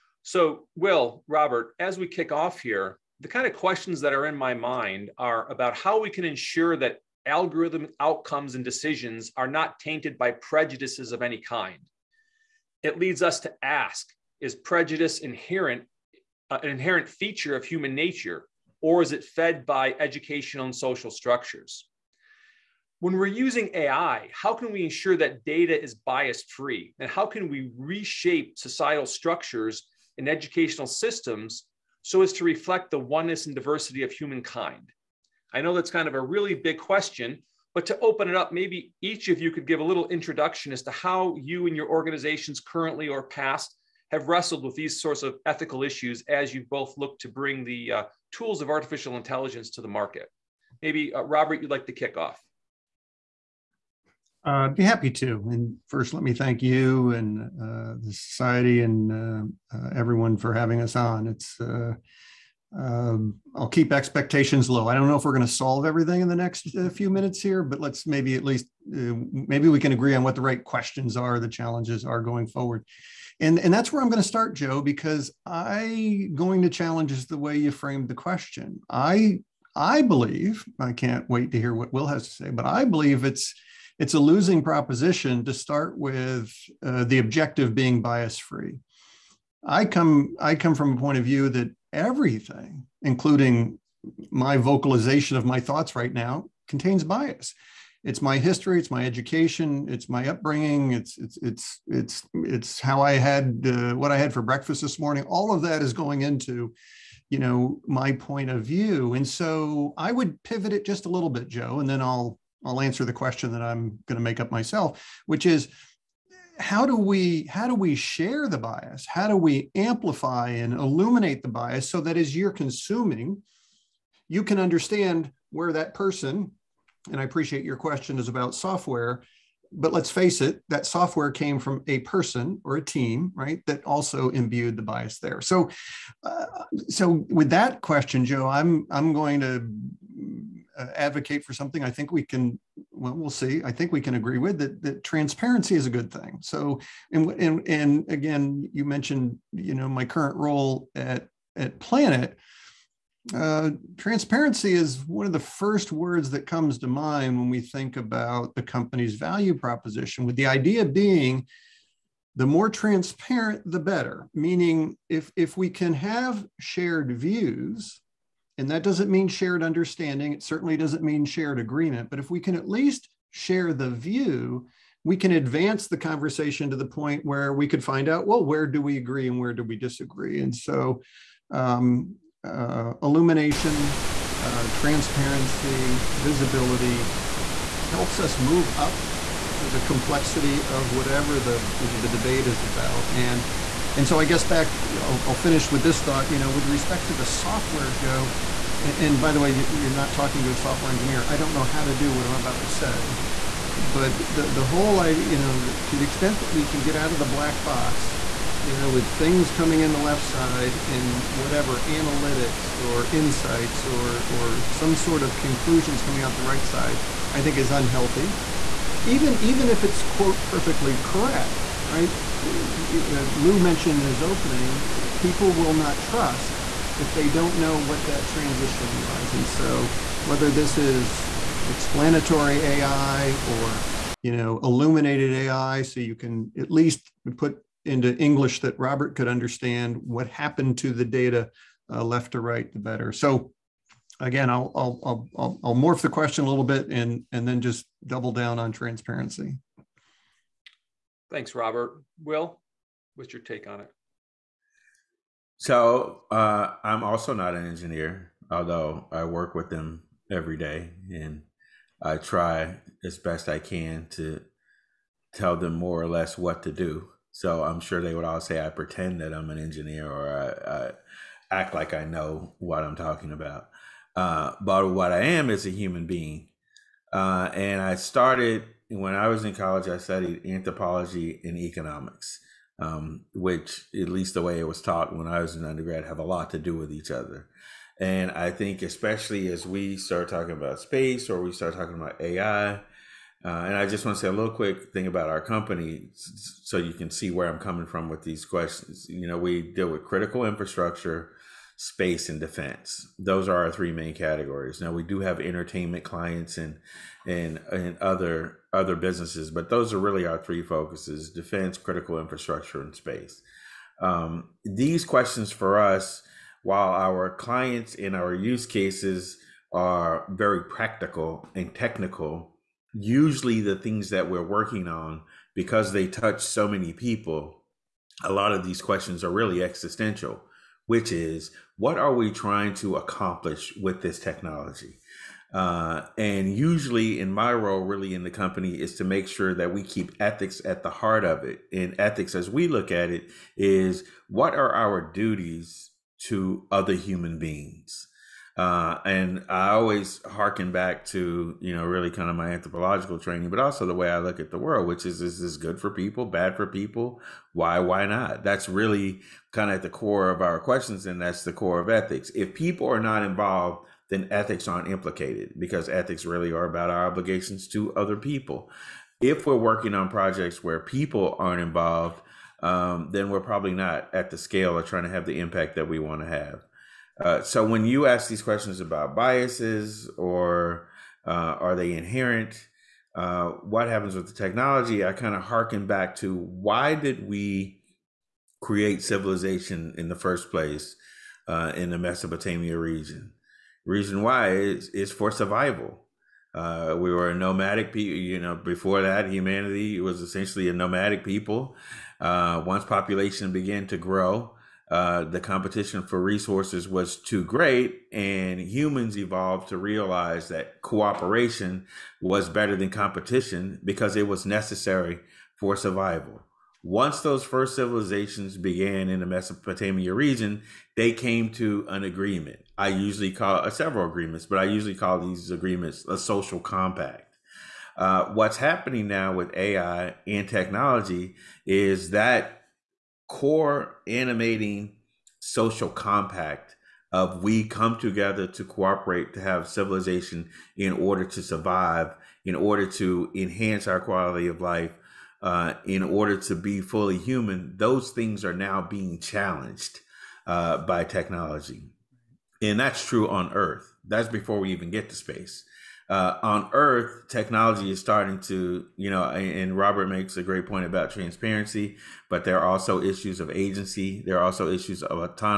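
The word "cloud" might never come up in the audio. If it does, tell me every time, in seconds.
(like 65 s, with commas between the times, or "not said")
not said.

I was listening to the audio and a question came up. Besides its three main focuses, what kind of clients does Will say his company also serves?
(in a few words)
entertainment clients.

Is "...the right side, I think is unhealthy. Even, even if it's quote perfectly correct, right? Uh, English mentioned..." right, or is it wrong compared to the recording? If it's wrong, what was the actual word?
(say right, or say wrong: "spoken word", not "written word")
wrong: "Lou", not "English".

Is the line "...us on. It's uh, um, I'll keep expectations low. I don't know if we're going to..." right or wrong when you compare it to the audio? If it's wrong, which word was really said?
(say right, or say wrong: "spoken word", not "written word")
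right.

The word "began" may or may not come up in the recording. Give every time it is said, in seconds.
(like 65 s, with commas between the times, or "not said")
403 s, 418 s.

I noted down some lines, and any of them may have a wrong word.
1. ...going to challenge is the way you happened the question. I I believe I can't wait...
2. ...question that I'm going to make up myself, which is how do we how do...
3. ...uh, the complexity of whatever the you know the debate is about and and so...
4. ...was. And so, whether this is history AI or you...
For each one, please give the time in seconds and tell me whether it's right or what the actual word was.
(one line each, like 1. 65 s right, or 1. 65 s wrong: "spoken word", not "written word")
1. 76 s wrong: "framed", not "happened"
2. 113 s right
3. 189 s right
4. 228 s wrong: "explanatory", not "history".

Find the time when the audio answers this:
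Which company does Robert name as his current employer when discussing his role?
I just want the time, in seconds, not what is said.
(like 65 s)
151 s.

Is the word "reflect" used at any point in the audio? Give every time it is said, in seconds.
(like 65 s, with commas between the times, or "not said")
32 s.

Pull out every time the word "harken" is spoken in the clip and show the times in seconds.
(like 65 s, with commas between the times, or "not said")
350 s, 385 s.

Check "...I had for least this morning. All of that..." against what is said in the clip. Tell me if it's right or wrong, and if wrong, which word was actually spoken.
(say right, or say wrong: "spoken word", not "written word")
wrong: "breakfast", not "least".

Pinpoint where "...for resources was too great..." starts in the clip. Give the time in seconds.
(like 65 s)
406 s.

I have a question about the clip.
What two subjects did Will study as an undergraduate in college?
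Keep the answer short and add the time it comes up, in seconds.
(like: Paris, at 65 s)
anthropology and economics, at 280 s.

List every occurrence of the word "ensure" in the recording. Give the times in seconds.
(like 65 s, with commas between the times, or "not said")
6 s, 24 s.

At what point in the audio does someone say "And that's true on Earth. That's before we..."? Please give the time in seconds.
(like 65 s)
452 s.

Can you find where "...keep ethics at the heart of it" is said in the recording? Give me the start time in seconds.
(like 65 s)
339 s.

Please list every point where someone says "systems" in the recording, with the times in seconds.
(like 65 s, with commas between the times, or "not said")
30 s.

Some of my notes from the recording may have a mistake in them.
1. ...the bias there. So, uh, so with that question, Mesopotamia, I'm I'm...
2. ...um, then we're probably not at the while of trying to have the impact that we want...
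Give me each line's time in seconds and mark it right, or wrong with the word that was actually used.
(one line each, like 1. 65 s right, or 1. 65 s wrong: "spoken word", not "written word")
1. 134 s wrong: "Joe", not "Mesopotamia"
2. 372 s wrong: "scale", not "while".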